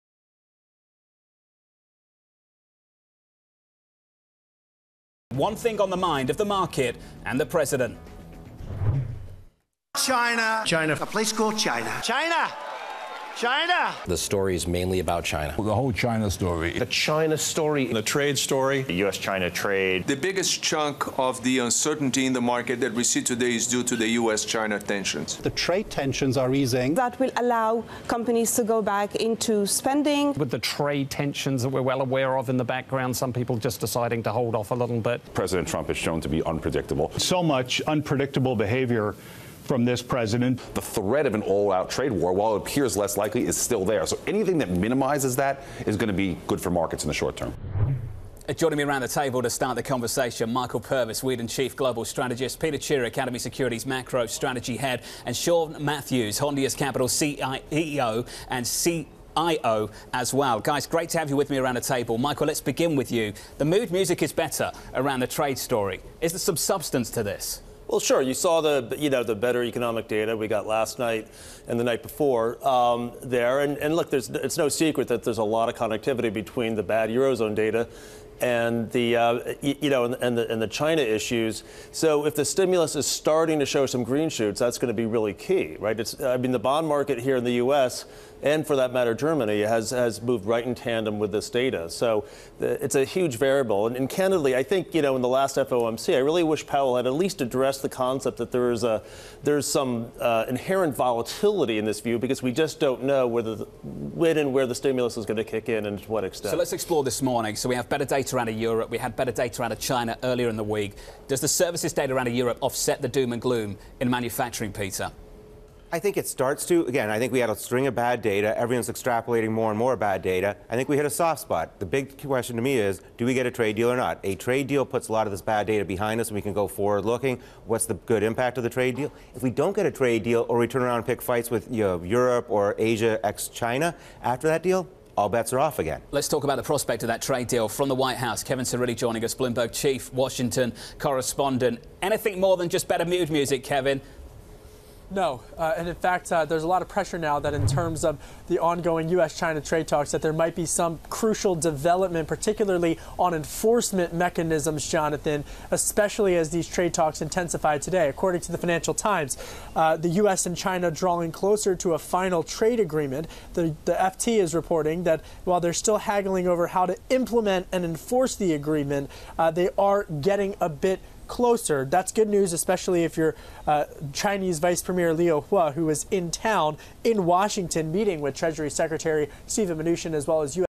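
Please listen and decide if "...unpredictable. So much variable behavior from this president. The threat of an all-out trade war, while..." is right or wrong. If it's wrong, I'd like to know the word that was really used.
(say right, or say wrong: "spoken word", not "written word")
wrong: "unpredictable", not "variable".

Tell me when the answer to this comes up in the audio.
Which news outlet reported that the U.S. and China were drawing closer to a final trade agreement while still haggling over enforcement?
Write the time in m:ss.
2:38.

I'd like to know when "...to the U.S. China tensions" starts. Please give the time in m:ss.
0:23.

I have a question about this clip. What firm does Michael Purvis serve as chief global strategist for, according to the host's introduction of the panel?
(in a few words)
Weeden.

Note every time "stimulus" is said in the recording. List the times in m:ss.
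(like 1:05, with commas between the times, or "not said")
1:22, 1:44.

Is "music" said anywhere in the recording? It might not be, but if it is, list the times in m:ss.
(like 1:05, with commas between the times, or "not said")
1:03, 2:23.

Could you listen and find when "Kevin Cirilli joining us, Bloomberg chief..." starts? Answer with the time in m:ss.
2:18.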